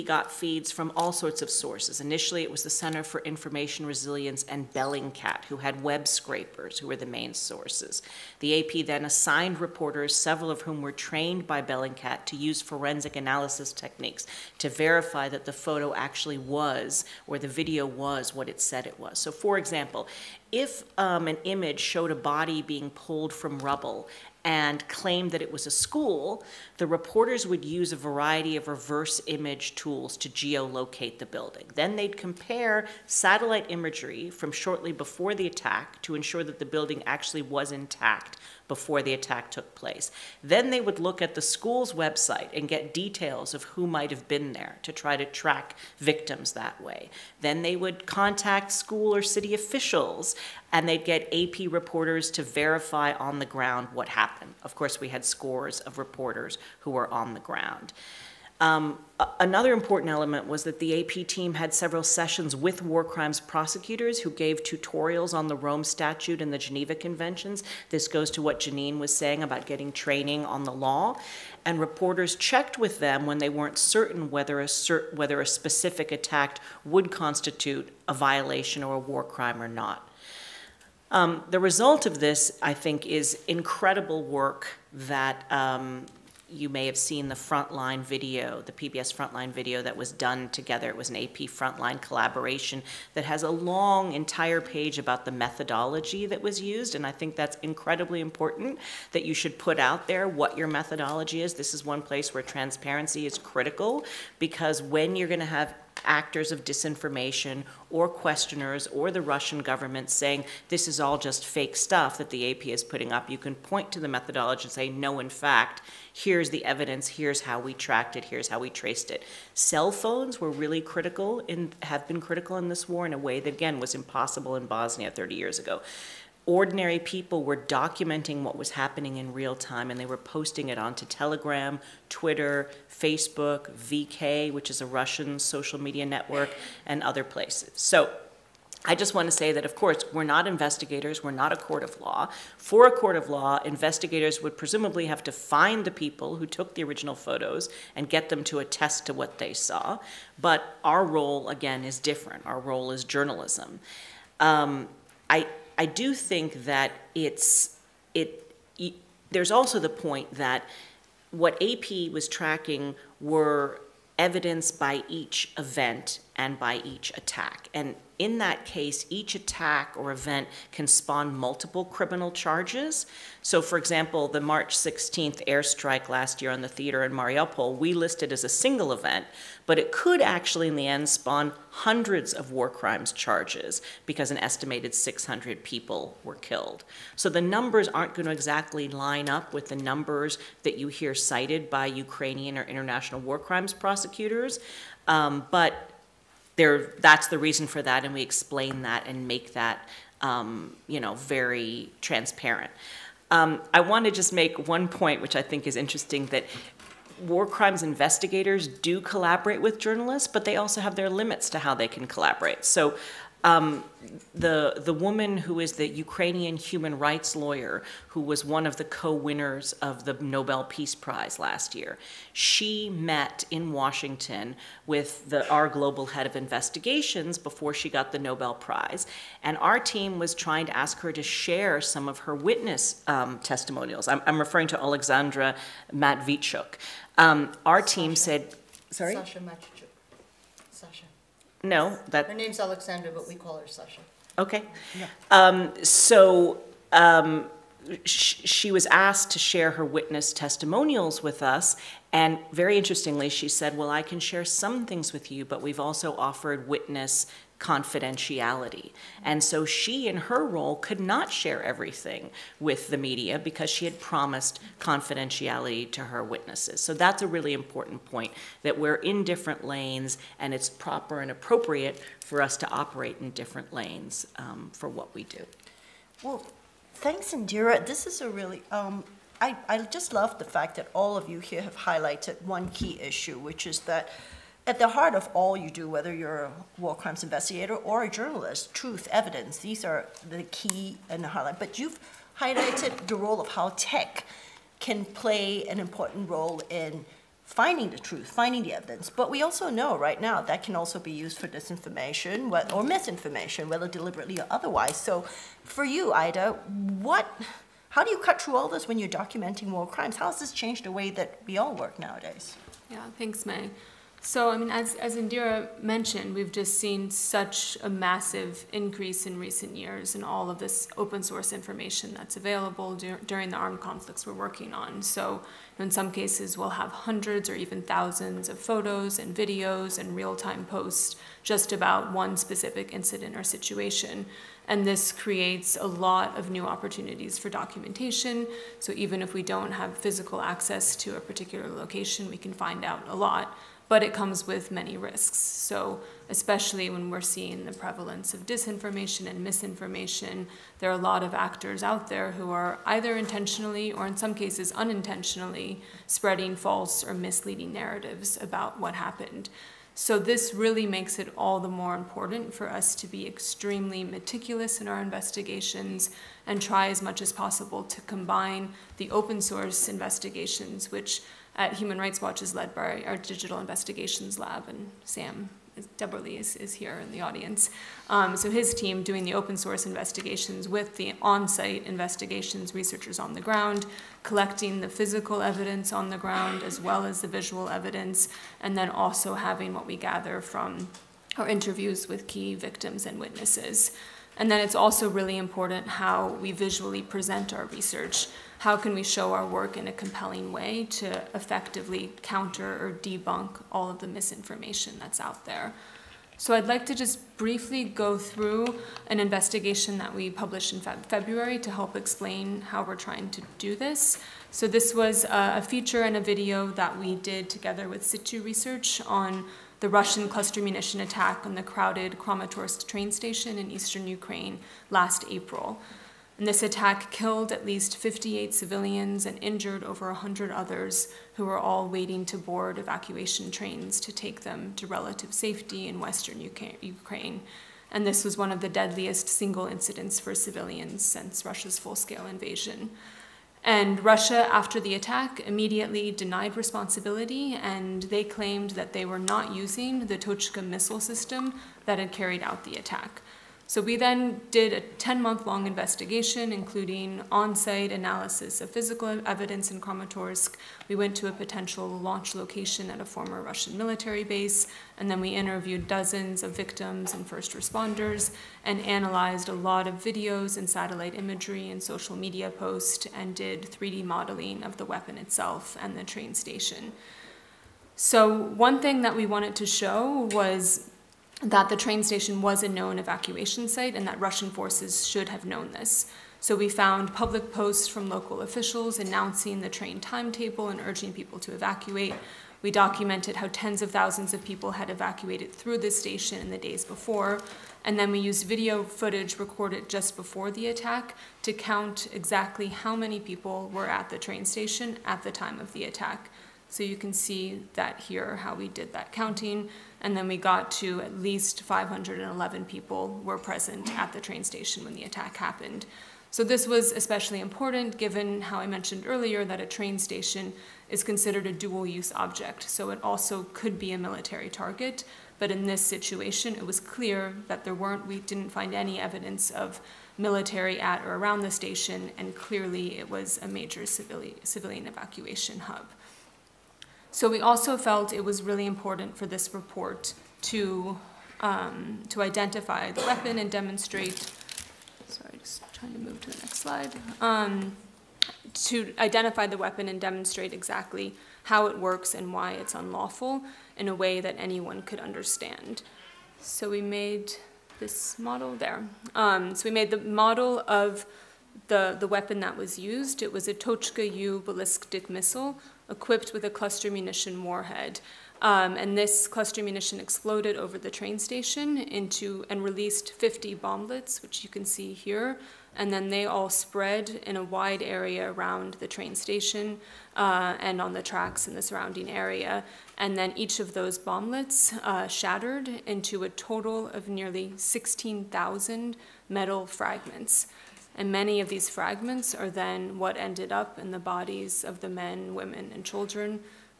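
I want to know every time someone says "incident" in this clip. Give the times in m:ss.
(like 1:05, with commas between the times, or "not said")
5:32, 7:19.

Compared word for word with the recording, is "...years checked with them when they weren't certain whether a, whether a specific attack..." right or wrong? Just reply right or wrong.
wrong.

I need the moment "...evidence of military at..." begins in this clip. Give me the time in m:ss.
8:48.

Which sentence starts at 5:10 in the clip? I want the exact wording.
How has this changed the way that we all work nowadays?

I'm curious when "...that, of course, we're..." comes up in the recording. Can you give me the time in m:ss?
2:19.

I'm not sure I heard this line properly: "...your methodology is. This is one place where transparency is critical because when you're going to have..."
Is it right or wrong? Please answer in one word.
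right.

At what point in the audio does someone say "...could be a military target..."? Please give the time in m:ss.
8:43.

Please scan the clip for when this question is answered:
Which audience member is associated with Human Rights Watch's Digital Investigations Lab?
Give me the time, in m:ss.
6:15.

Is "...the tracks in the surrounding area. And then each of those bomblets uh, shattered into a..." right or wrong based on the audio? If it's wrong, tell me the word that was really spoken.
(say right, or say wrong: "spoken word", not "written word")
right.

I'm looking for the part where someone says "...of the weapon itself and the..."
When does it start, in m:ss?
7:54.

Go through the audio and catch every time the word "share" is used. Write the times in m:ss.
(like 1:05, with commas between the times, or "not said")
3:51, 4:09, 4:14, 4:21.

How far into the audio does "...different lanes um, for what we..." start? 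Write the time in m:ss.
4:33.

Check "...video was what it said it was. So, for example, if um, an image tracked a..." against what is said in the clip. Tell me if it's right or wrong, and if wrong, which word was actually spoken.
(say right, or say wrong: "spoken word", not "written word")
wrong: "showed", not "tracked".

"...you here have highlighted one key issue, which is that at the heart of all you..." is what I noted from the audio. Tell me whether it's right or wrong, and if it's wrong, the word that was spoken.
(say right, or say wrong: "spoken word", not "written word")
right.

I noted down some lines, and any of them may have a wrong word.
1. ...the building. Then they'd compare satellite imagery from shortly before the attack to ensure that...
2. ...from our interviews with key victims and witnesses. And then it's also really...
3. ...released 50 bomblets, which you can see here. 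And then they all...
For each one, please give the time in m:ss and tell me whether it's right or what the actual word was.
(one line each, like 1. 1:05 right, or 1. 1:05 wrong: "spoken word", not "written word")
1. 0:31 right
2. 6:30 right
3. 9:32 right.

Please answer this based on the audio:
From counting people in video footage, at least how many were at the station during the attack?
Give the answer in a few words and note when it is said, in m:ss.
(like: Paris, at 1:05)
511, at 8:31.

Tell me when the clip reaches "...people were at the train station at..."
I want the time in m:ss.
8:23.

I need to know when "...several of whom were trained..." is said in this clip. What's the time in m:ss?
0:10.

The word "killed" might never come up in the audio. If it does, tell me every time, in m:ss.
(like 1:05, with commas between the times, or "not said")
3:06, 7:07.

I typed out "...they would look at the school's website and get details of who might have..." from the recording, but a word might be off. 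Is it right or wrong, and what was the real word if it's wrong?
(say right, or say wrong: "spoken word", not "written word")
right.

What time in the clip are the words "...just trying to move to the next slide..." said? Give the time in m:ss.
9:05.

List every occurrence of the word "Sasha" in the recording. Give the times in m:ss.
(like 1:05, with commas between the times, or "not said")
3:59, 4:03.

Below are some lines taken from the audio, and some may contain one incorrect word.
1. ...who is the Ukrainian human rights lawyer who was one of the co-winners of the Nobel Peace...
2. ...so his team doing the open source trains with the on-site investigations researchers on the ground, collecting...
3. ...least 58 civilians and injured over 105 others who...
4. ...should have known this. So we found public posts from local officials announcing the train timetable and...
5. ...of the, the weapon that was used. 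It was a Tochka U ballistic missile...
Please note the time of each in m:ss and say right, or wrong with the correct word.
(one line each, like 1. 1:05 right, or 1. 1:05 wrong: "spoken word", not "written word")
1. 3:35 right
2. 6:18 wrong: "investigations", not "trains"
3. 7:07 wrong: "100", not "105"
4. 8:05 right
5. 9:20 right.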